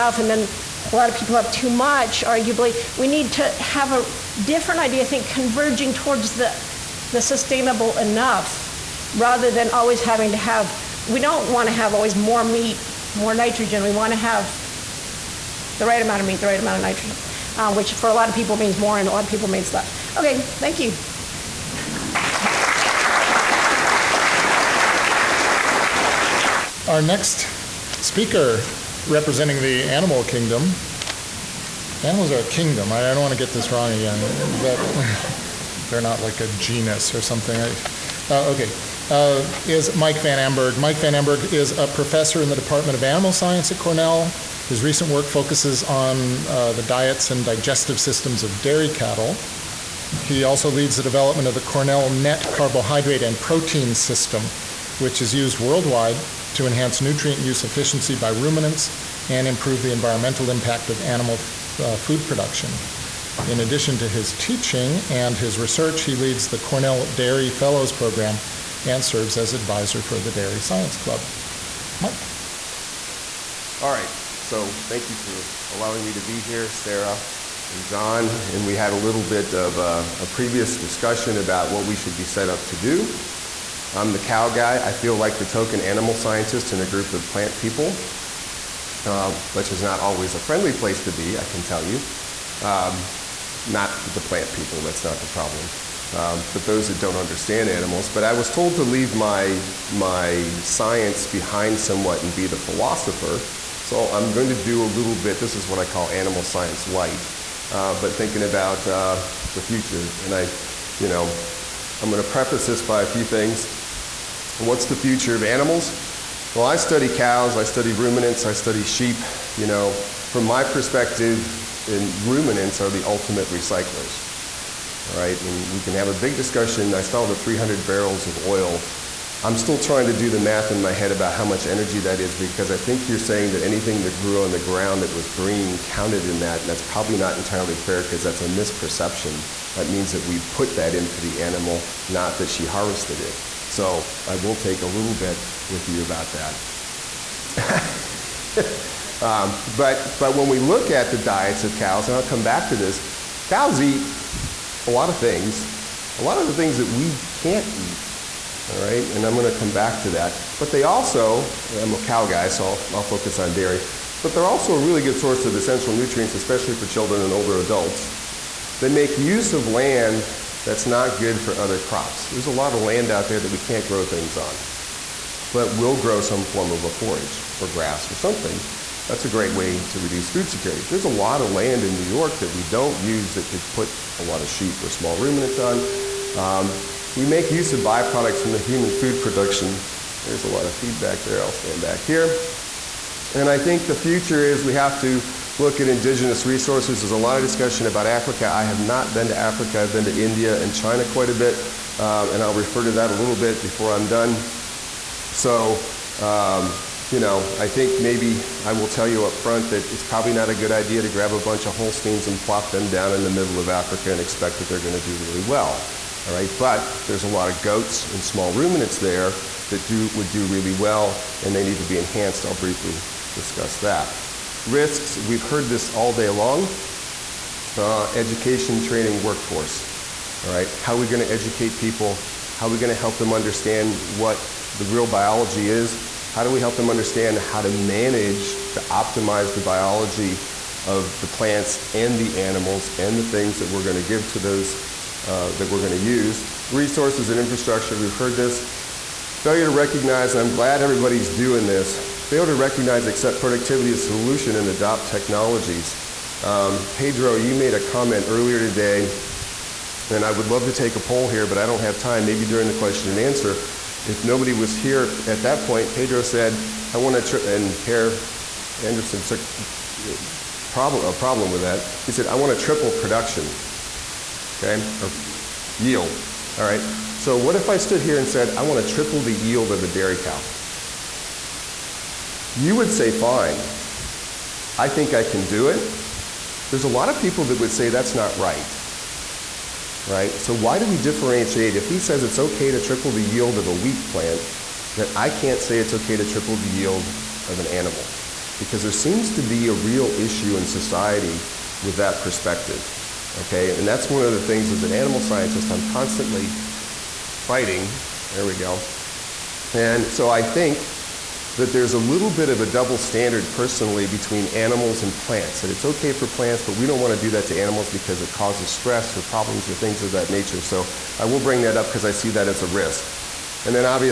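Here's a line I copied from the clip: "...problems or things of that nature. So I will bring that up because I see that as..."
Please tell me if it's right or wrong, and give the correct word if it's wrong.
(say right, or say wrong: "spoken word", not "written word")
right.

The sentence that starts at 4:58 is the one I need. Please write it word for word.
Because there seems to be a real issue in society with that perspective.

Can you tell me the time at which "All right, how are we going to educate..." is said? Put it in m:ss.
3:50.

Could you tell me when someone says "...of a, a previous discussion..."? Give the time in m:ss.
1:19.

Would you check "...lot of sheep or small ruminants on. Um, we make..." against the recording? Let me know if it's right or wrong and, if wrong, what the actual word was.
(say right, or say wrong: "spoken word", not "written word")
right.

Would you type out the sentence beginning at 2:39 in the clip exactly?
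And I'm going to come back to that.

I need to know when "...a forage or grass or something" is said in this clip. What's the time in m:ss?
2:56.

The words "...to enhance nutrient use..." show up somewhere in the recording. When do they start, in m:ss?
0:56.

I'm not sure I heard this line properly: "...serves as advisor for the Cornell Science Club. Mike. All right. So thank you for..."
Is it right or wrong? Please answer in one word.
wrong.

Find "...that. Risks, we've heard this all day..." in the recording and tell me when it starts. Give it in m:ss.
3:43.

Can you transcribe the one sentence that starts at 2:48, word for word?
They make use of land that's not good for other crops.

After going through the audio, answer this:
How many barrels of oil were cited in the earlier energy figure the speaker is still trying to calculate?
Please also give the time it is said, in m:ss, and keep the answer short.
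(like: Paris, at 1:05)
300, at 2:07.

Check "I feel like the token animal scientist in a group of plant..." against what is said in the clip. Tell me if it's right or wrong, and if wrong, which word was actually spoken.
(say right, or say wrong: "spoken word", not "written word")
right.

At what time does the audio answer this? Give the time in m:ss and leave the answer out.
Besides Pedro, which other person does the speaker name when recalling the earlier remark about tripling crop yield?
4:27.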